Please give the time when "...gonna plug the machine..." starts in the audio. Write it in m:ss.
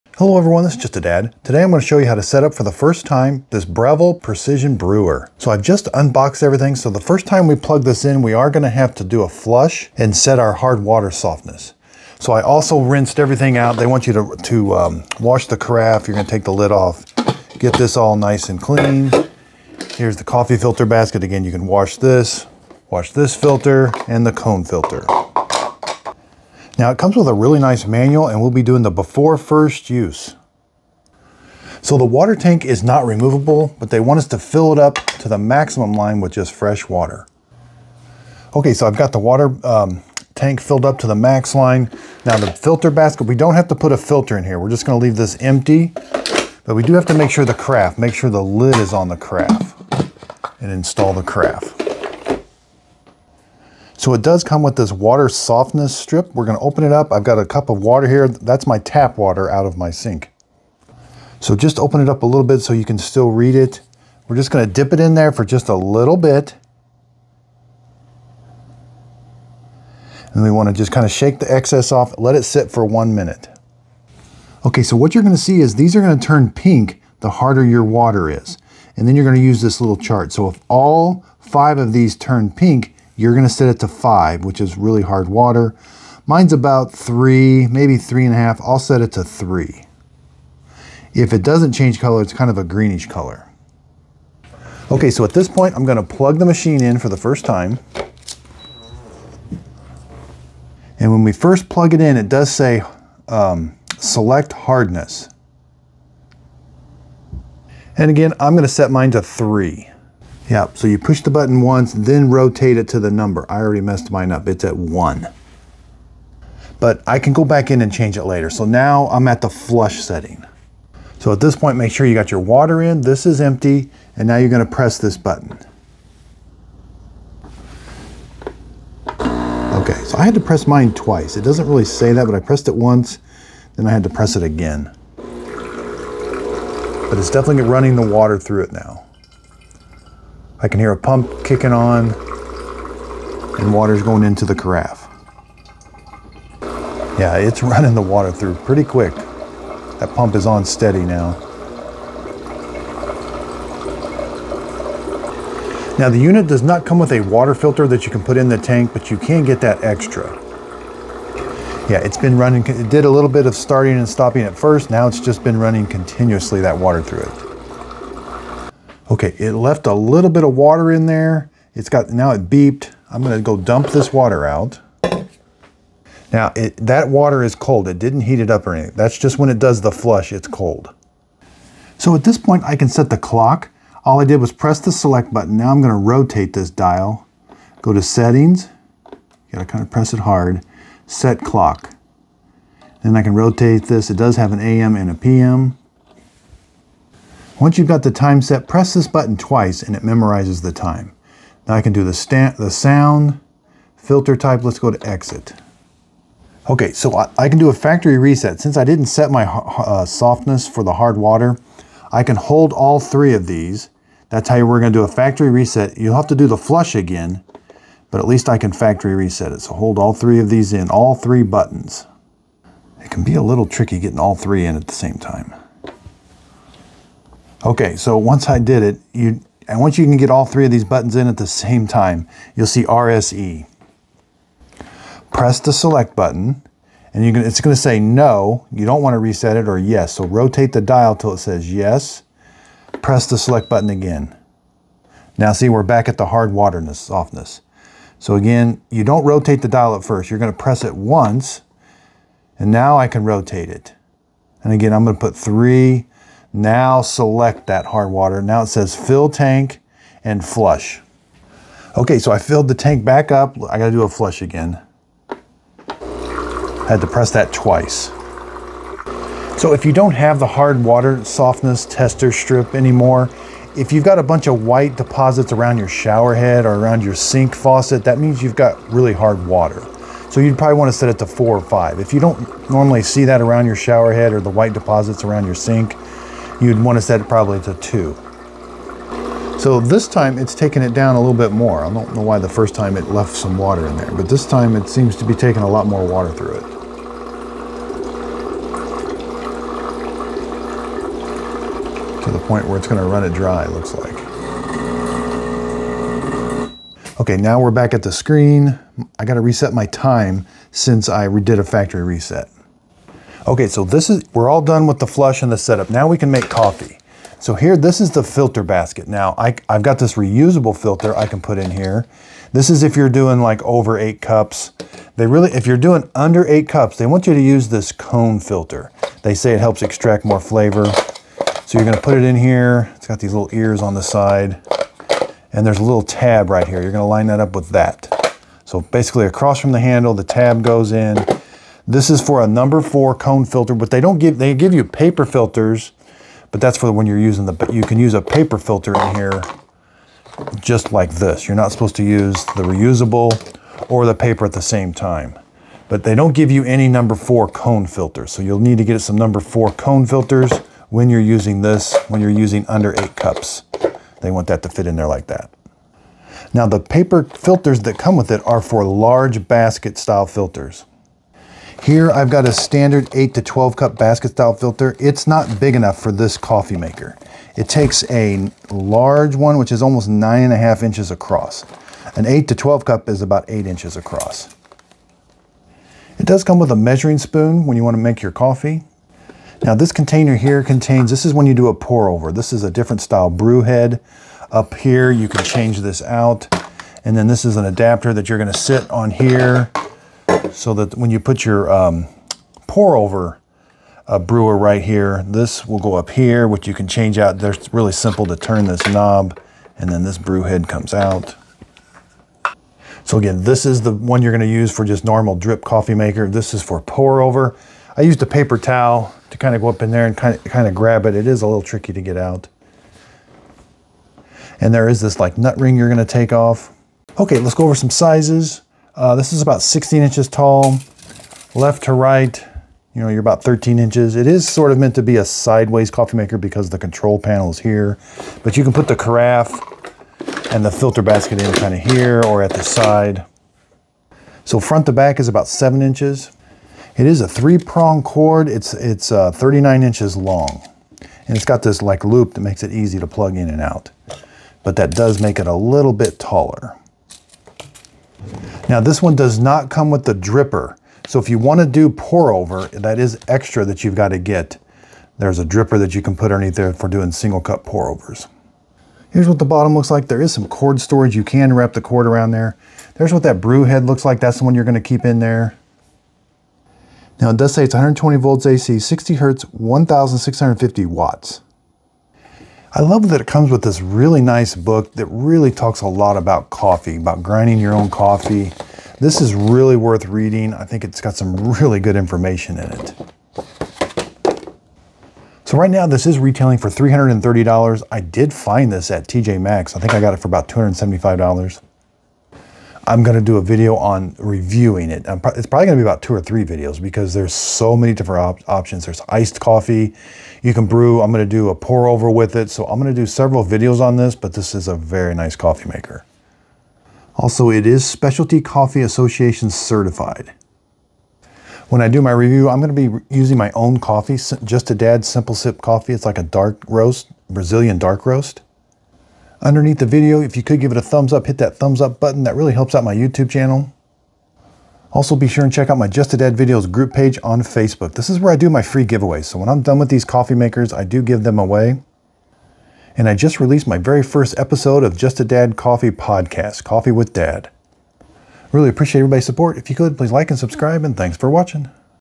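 1:35.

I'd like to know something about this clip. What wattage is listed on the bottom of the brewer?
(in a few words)
1,650 watts.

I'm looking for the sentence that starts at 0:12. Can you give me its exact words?
So I also rinsed everything out.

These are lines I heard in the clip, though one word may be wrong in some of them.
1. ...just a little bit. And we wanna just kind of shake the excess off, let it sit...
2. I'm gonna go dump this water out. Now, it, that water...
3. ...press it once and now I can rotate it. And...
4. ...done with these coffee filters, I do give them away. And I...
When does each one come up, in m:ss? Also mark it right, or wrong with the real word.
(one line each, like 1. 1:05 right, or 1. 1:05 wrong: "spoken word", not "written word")
1. 1:05 right
2. 2:53 right
3. 4:10 right
4. 8:59 wrong: "makers", not "filters".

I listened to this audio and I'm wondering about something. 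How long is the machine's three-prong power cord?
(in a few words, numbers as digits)
39 inches.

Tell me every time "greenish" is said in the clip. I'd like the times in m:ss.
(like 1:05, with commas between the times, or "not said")
1:32.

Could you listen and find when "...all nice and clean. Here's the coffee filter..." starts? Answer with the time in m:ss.
0:17.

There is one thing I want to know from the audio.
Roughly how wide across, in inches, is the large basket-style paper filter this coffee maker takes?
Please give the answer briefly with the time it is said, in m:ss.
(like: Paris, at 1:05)
9.5 inches, at 6:20.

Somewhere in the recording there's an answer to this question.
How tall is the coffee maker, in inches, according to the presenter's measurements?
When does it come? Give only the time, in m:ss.
7:09.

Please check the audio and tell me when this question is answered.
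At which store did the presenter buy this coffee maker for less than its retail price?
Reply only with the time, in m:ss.
8:19.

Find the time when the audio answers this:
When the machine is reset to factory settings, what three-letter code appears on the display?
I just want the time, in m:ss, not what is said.
3:52.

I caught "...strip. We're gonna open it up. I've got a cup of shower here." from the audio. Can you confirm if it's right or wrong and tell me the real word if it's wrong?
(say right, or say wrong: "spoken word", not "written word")
wrong: "water", not "shower".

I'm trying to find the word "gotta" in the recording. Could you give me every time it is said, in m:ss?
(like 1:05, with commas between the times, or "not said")
3:09, 4:23, 5:09.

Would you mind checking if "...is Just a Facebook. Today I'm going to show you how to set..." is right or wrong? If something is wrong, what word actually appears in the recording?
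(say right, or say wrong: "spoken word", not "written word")
wrong: "Dad", not "Facebook".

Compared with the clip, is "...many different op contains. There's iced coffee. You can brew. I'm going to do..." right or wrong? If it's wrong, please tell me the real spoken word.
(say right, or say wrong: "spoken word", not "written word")
wrong: "options", not "contains".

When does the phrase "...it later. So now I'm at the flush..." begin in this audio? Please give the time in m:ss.
1:58.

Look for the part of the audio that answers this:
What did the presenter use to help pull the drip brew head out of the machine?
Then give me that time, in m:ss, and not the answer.
6:58.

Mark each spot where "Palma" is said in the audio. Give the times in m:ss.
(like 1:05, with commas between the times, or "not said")
not said.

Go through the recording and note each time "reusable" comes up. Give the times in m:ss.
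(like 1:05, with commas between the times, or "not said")
5:20, 5:52.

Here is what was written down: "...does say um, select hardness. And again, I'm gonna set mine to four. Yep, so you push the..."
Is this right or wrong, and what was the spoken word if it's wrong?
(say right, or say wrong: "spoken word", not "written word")
wrong: "three", not "four".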